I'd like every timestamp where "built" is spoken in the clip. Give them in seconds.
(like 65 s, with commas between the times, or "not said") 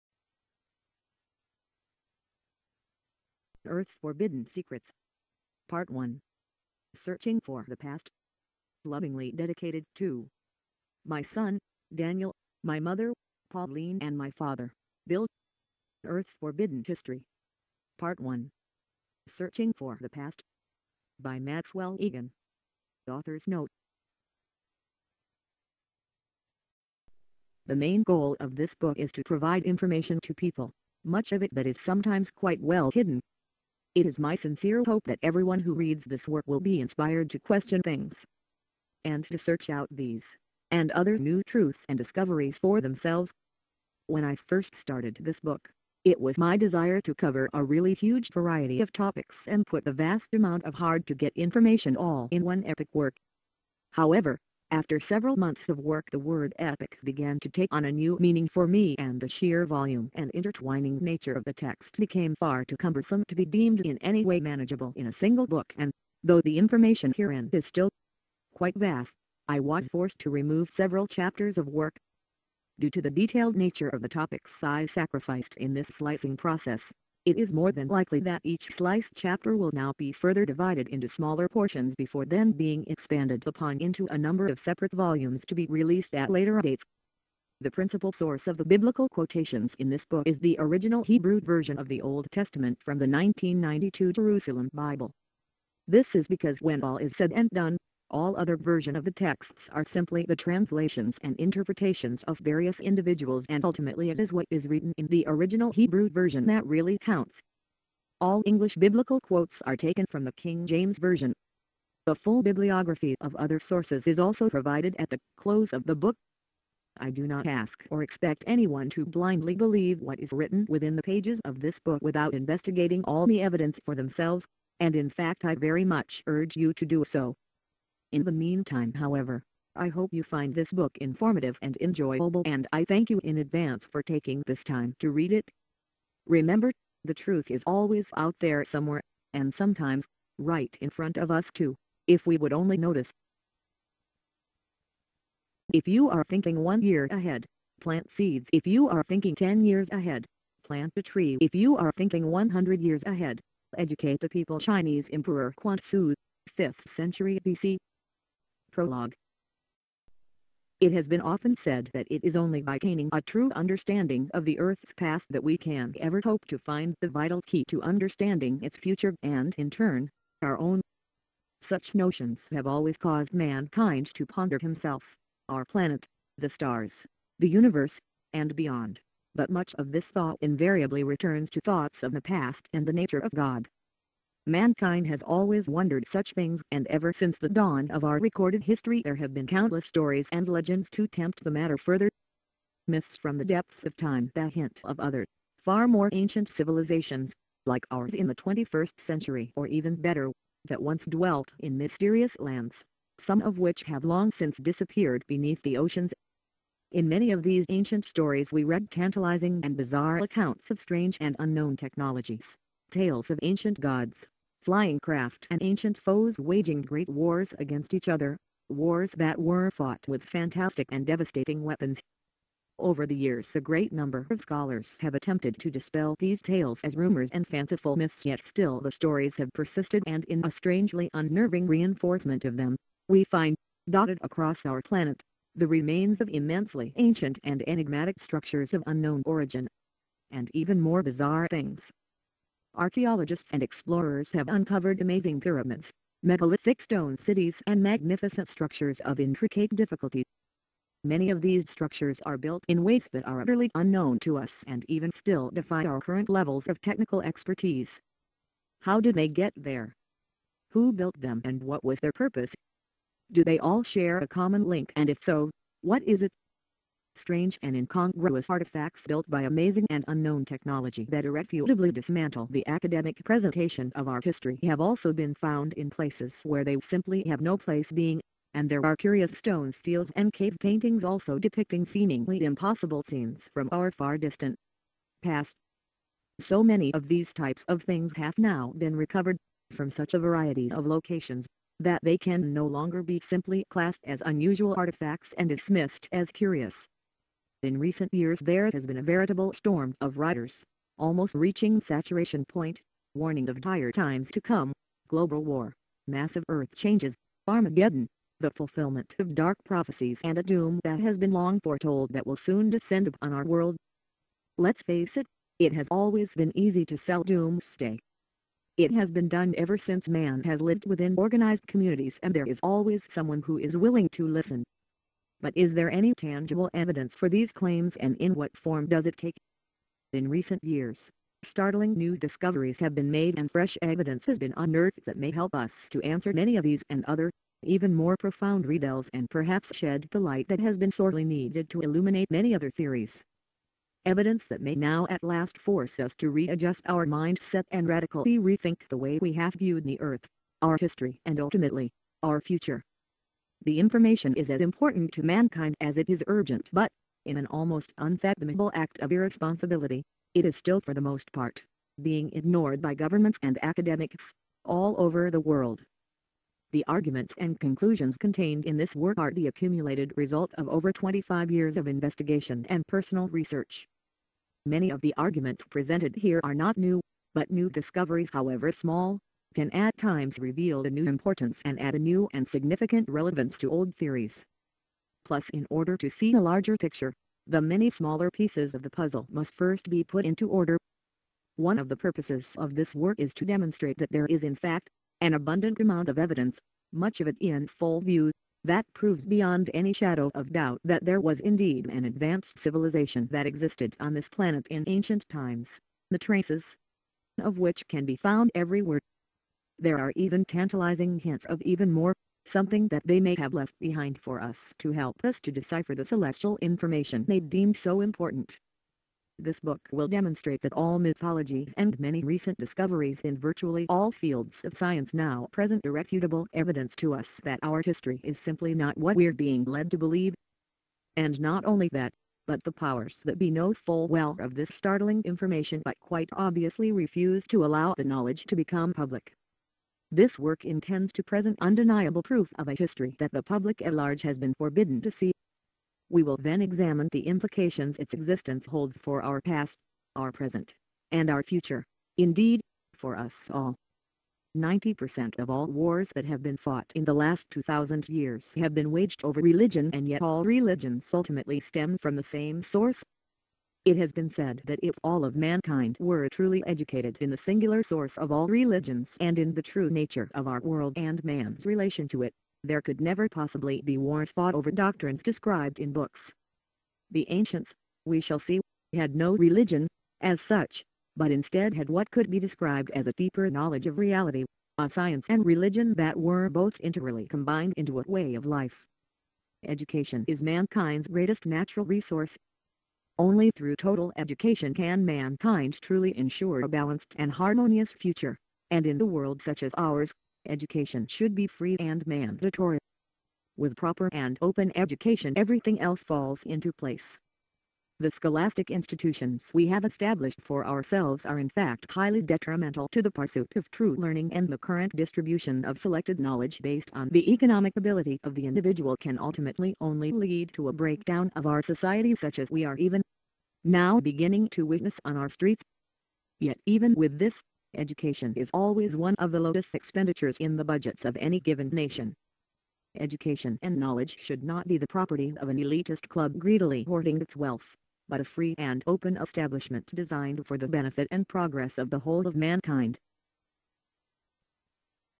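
252 s, 260 s, 269 s.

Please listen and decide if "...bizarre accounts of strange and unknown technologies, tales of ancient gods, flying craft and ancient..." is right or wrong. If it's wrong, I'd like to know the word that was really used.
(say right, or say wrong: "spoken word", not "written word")
right.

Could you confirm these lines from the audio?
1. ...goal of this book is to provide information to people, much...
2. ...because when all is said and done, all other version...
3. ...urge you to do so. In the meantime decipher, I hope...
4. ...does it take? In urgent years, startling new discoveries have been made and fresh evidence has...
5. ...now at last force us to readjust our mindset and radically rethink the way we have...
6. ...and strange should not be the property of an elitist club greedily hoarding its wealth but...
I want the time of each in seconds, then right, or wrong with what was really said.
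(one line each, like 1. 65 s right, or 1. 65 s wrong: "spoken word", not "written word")
1. 28 s right
2. 96 s right
3. 126 s wrong: "however", not "decipher"
4. 328 s wrong: "recent", not "urgent"
5. 344 s right
6. 533 s wrong: "knowledge", not "strange".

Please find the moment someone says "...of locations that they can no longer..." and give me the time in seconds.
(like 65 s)
290 s.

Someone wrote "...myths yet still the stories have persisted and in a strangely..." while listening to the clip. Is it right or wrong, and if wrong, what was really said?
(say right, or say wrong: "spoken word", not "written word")
right.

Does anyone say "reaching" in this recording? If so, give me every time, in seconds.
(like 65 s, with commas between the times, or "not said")
301 s.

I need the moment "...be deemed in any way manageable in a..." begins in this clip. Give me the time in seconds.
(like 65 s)
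63 s.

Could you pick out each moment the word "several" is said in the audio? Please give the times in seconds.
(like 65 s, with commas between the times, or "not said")
55 s, 70 s.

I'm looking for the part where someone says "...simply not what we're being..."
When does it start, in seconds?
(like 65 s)
428 s.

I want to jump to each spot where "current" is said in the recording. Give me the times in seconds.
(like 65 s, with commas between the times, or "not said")
255 s, 514 s.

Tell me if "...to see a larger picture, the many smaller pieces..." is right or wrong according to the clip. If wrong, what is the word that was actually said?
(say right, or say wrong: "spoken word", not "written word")
right.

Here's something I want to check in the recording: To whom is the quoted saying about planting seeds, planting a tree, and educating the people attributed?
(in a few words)
Emperor Quan Su.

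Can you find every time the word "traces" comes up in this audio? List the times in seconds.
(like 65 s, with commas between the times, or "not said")
406 s.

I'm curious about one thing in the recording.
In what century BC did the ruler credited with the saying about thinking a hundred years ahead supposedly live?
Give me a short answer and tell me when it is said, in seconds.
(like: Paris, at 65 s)
5th century BC, at 156 s.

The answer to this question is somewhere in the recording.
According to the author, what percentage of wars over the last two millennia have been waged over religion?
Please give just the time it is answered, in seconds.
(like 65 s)
454 s.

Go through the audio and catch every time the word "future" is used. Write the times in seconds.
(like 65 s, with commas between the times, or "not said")
168 s, 352 s, 451 s, 497 s.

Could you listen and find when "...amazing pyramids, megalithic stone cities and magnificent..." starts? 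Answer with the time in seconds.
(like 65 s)
245 s.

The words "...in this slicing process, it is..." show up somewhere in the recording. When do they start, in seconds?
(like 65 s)
75 s.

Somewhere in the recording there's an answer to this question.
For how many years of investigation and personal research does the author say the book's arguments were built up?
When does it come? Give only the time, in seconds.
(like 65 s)
370 s.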